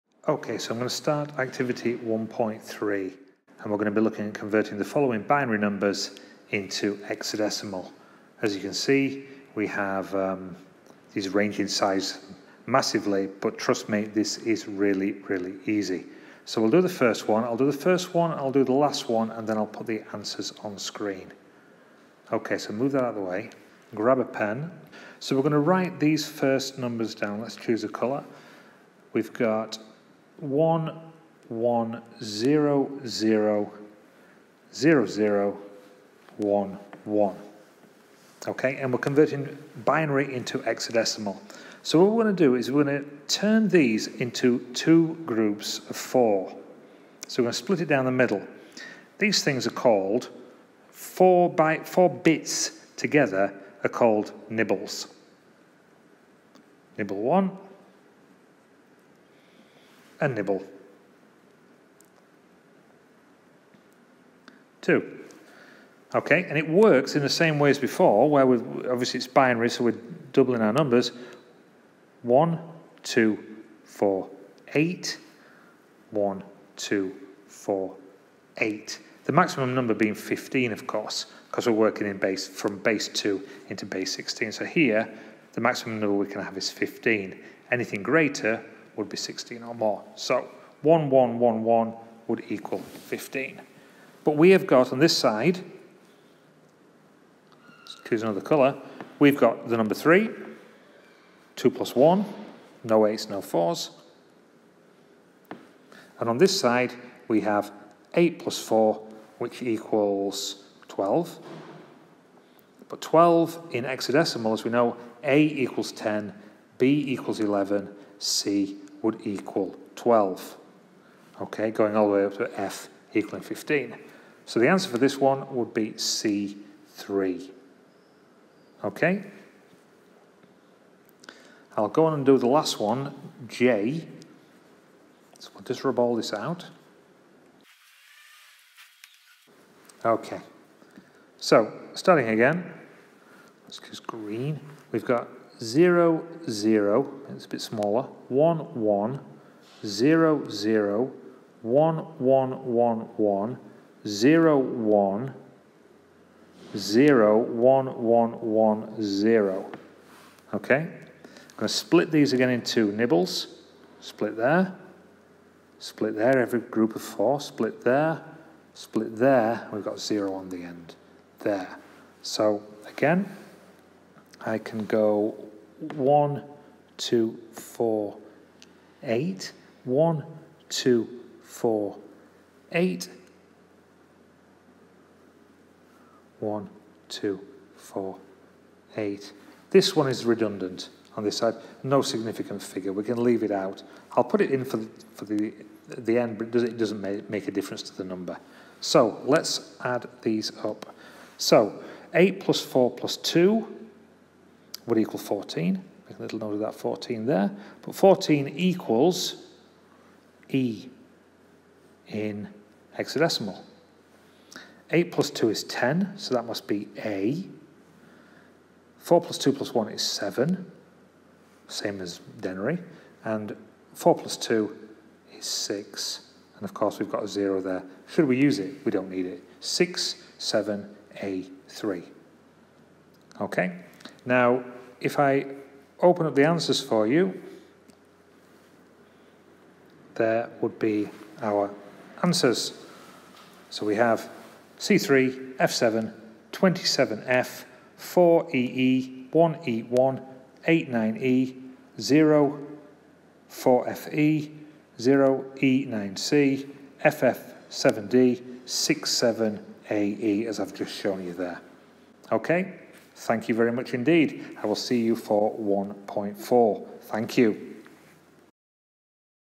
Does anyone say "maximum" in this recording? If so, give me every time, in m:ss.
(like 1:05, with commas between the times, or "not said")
1:19, 1:25.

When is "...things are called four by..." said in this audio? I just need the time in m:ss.
0:49.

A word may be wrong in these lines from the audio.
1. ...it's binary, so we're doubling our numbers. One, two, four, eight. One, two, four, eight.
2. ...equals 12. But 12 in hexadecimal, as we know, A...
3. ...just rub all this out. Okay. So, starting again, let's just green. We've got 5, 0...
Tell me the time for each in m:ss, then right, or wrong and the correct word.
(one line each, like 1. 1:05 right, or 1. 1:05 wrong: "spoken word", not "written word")
1. 1:09 right
2. 1:49 right
3. 2:15 wrong: "0", not "5".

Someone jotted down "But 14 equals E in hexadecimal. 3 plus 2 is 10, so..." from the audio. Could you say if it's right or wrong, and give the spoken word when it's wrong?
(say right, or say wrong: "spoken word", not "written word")
wrong: "8", not "3".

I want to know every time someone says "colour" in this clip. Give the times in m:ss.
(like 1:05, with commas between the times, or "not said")
0:27, 1:38.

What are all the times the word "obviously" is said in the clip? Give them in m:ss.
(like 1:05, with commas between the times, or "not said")
1:08.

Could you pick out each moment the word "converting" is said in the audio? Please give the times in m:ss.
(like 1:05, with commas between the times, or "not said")
0:04, 0:38.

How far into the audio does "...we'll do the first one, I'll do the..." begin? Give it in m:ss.
0:16.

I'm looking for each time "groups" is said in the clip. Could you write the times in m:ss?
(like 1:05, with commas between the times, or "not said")
0:45, 2:46.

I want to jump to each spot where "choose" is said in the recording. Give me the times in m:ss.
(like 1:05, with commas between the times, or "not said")
0:27, 1:38.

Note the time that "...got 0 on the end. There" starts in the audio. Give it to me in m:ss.
2:49.